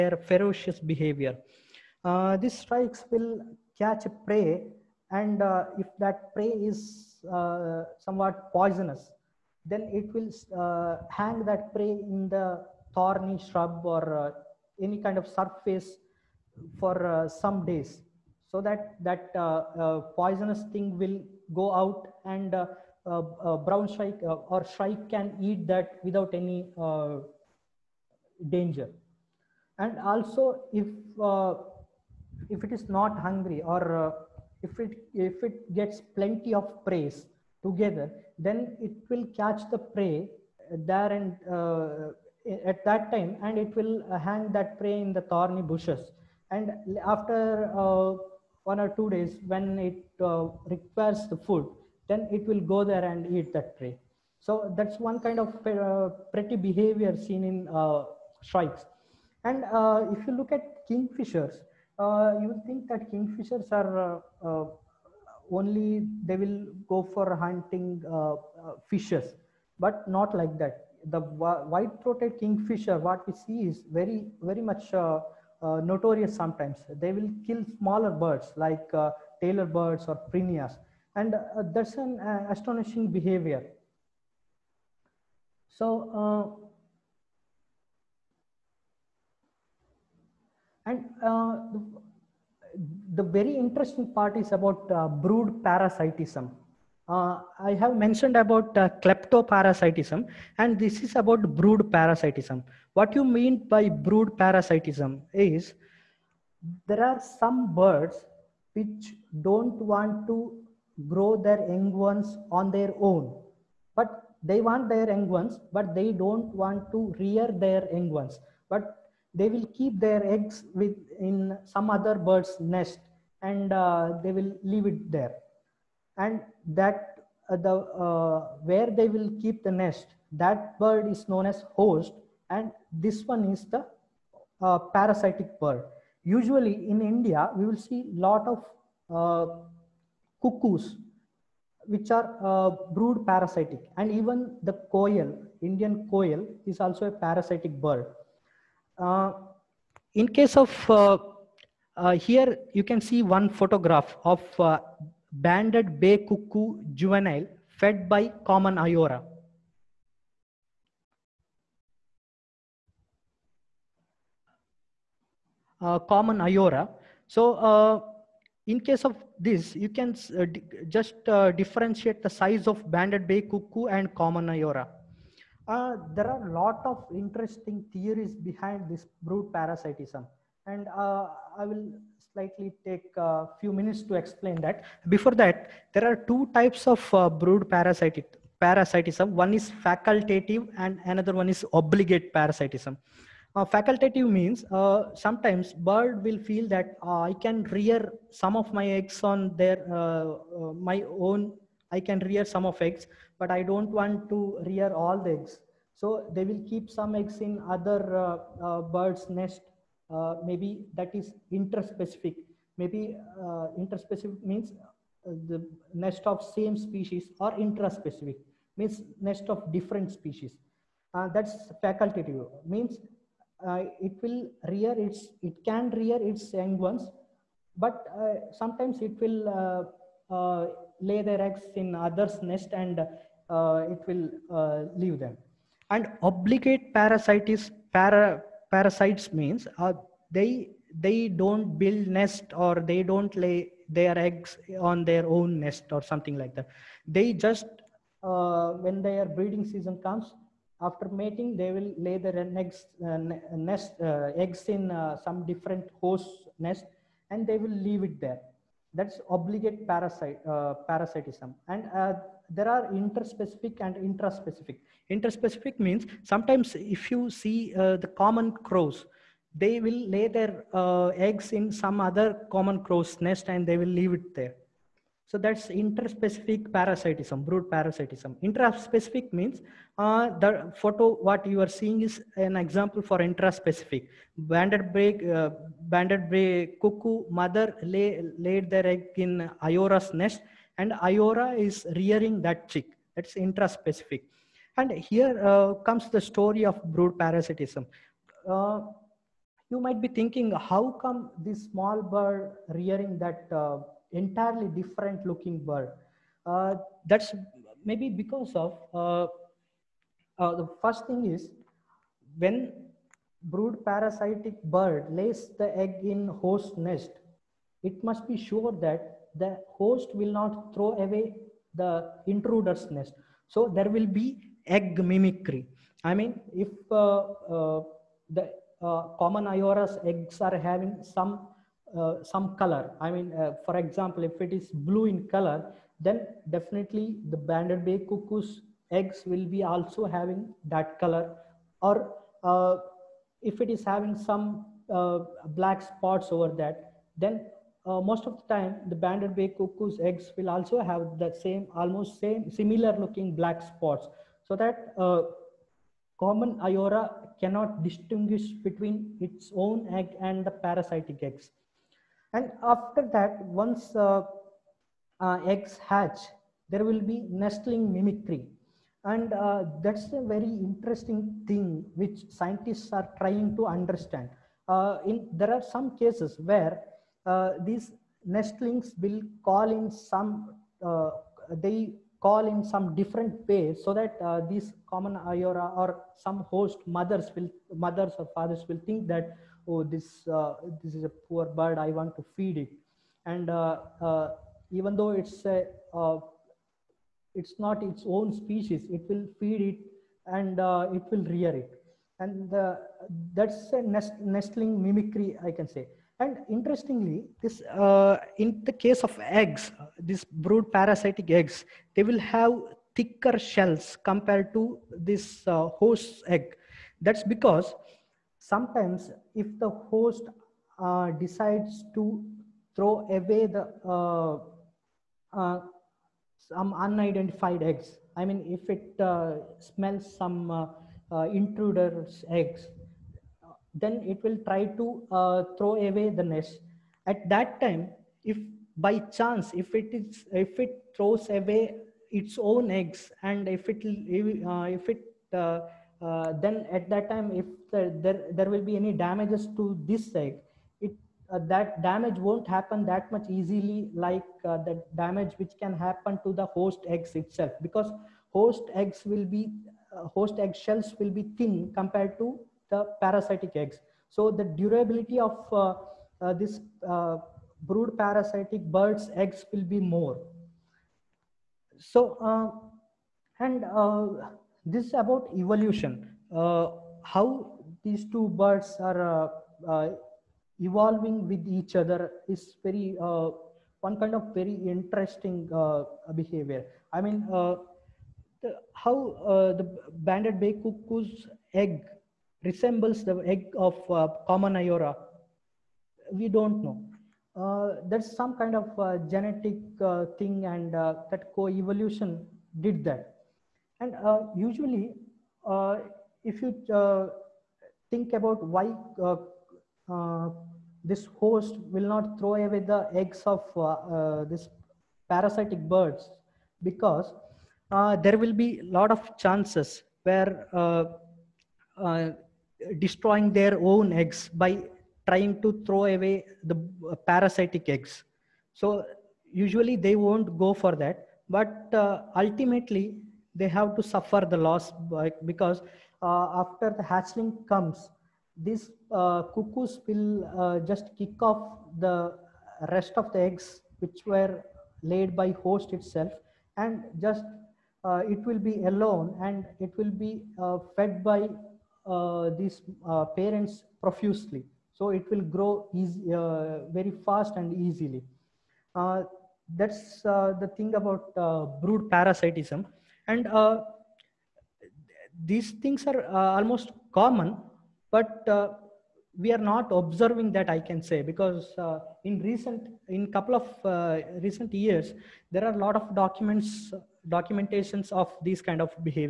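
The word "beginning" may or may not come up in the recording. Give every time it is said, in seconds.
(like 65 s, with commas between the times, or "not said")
not said.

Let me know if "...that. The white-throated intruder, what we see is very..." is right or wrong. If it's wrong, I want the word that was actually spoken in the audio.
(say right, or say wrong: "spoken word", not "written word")
wrong: "kingfisher", not "intruder".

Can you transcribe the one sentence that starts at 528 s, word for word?
So usually they won't go for that.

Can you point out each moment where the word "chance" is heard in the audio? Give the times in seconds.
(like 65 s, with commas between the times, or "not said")
439 s, 519 s.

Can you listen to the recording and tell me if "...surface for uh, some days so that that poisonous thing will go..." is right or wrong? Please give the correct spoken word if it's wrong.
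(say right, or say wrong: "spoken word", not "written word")
right.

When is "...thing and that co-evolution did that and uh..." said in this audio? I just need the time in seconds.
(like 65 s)
500 s.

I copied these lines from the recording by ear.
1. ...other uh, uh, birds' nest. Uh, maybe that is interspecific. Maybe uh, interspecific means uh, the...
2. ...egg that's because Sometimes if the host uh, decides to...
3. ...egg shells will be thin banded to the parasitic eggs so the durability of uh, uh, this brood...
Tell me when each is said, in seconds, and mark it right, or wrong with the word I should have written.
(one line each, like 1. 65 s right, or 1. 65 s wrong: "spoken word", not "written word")
1. 207 s right
2. 416 s right
3. 460 s wrong: "compared", not "banded".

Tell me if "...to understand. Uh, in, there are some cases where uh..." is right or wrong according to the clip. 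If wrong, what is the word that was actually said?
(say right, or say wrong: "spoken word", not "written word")
right.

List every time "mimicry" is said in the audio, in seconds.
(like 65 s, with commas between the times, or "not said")
325 s, 367 s, 404 s.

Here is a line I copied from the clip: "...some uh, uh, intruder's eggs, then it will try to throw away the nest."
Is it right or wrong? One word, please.
right.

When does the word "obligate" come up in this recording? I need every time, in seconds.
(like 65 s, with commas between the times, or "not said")
191 s, 236 s, 259 s.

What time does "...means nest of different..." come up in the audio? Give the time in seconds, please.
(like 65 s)
218 s.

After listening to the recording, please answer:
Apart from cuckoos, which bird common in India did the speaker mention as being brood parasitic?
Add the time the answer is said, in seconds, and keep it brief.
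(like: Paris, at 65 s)
Indian koel, at 145 s.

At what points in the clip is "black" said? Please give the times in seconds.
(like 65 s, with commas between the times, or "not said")
345 s, 353 s.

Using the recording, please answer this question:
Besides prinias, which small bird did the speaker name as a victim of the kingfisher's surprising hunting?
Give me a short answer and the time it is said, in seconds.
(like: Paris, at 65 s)
Tailor birds, at 79 s.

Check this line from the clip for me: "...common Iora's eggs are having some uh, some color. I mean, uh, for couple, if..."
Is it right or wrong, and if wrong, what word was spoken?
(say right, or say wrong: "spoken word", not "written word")
wrong: "example", not "couple".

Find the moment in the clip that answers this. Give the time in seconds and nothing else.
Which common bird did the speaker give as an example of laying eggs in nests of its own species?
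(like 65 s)
268 s.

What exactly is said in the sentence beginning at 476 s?
Uh, how these two birds are uh, uh evolving with each other is very uh, one kind of very interesting uh, behavior.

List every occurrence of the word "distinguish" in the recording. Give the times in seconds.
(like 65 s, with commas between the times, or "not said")
357 s.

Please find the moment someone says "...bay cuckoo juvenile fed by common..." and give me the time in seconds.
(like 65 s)
155 s.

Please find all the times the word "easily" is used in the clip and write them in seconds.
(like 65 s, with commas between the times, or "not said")
453 s, 557 s.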